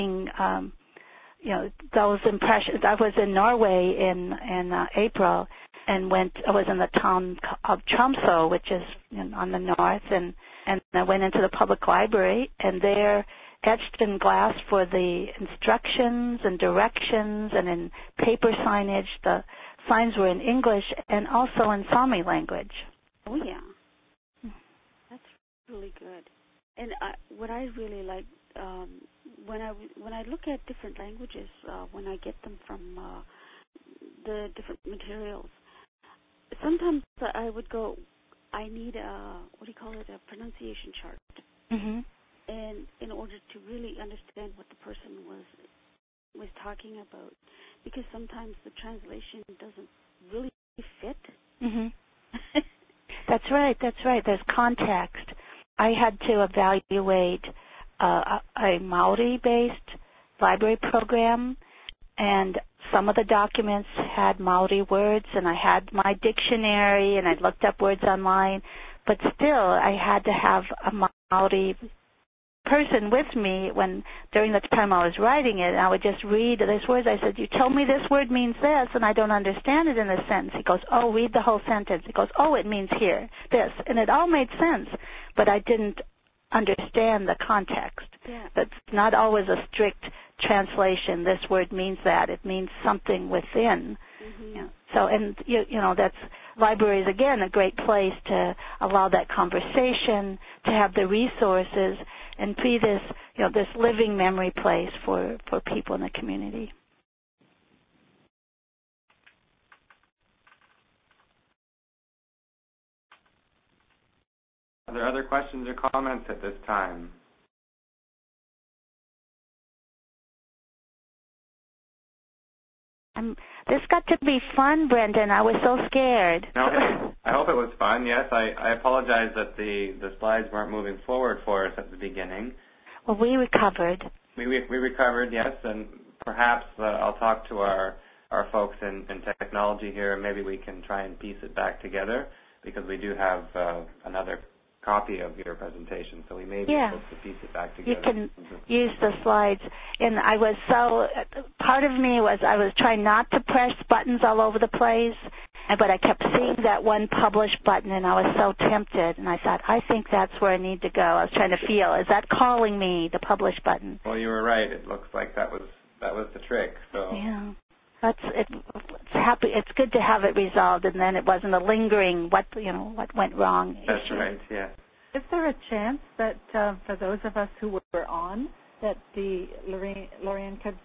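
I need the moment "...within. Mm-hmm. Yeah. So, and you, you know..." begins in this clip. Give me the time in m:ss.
1:33.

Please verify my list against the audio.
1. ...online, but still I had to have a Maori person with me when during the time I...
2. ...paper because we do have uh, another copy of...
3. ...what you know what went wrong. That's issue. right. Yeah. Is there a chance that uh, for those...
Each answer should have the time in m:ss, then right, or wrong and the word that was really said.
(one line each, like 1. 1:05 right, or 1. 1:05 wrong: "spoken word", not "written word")
1. 1:08 right
2. 2:21 wrong: "together", not "paper"
3. 2:52 right.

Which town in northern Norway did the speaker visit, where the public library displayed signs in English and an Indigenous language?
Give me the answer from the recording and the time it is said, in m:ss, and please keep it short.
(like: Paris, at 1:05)
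Tromso, at 0:07.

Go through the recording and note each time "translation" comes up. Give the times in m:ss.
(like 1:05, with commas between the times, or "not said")
0:48, 1:30.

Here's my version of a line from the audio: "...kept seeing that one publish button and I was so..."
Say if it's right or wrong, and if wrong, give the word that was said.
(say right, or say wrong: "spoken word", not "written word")
right.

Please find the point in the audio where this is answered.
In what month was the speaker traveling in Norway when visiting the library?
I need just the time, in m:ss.
0:04.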